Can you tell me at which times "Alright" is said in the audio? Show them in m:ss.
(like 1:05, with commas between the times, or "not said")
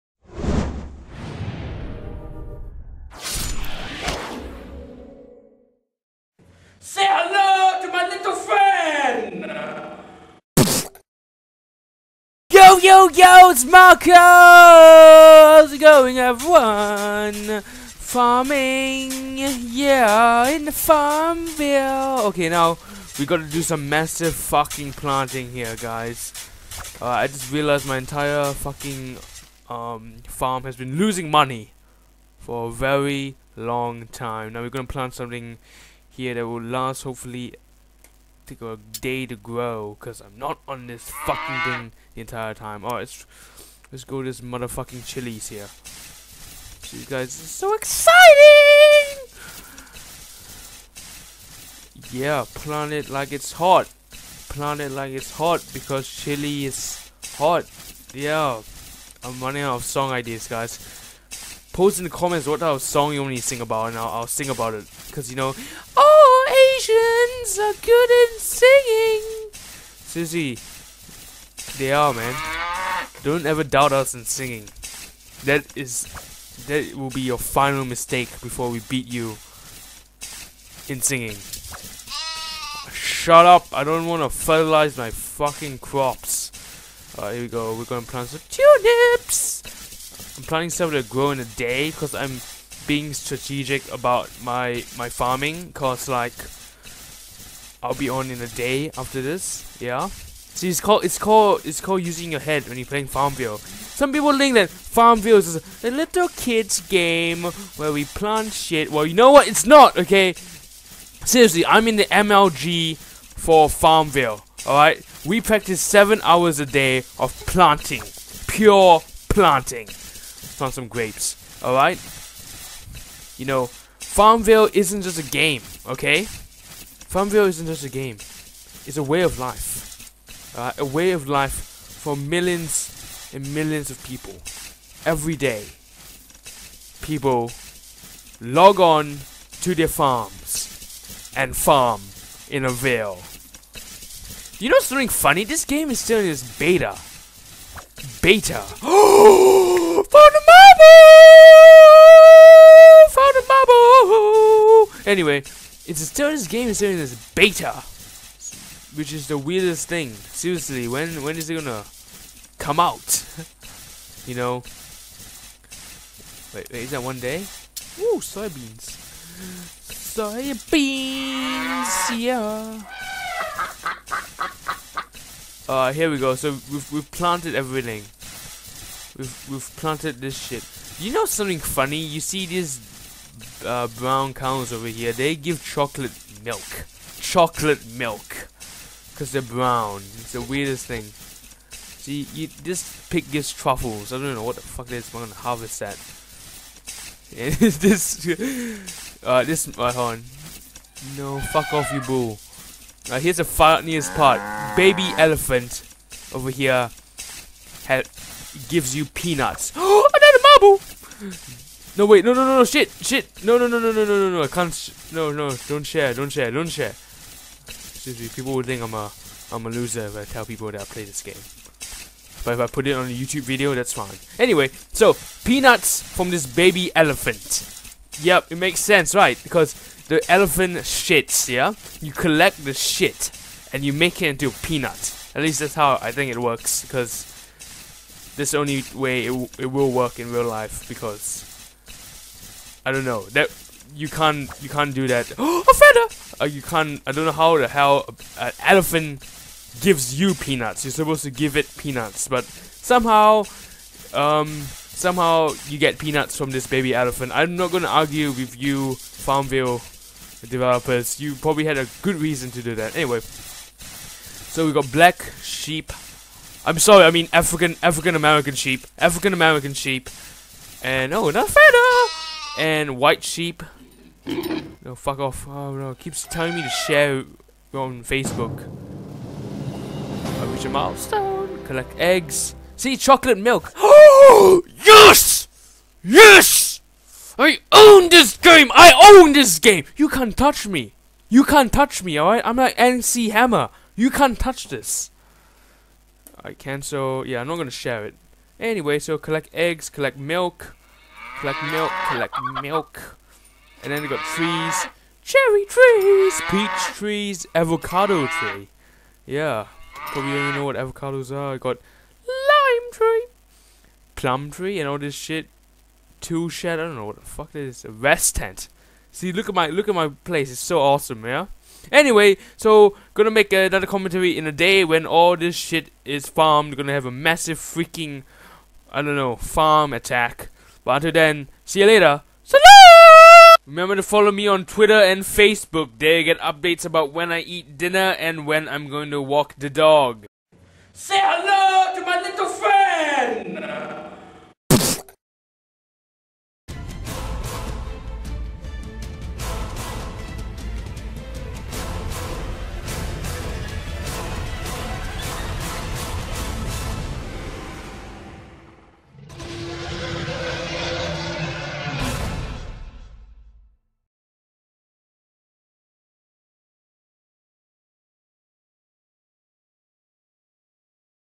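0:42, 1:27.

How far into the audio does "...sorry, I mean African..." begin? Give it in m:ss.
4:26.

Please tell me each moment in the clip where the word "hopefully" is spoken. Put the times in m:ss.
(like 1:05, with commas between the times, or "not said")
0:37.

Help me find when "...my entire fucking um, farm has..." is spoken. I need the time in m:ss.
0:27.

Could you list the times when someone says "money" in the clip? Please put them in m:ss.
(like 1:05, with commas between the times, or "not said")
0:31.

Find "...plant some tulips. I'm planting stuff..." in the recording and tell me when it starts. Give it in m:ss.
1:28.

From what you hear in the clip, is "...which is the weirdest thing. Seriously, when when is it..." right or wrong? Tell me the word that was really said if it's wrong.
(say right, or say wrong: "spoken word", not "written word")
right.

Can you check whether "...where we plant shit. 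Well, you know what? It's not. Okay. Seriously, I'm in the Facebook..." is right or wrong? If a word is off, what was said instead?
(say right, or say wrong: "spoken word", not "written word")
wrong: "MLG", not "Facebook".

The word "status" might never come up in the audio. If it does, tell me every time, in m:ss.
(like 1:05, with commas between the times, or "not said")
not said.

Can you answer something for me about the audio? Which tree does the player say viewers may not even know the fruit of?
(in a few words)
Avocado tree.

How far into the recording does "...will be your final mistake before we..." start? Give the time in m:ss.
1:16.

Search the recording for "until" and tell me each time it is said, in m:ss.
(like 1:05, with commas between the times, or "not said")
5:31.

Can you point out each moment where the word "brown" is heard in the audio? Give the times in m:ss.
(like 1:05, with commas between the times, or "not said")
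3:03, 3:09.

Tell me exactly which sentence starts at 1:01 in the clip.
Post in the comments what type of song you want me to sing about, and I'll, I'll sing about it.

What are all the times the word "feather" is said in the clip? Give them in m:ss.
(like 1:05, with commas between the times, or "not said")
4:05, 4:31.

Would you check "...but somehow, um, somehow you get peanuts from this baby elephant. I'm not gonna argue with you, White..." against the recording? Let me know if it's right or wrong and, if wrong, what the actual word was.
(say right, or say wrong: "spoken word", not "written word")
wrong: "Farmville", not "White".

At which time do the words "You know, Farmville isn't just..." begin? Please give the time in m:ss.
2:03.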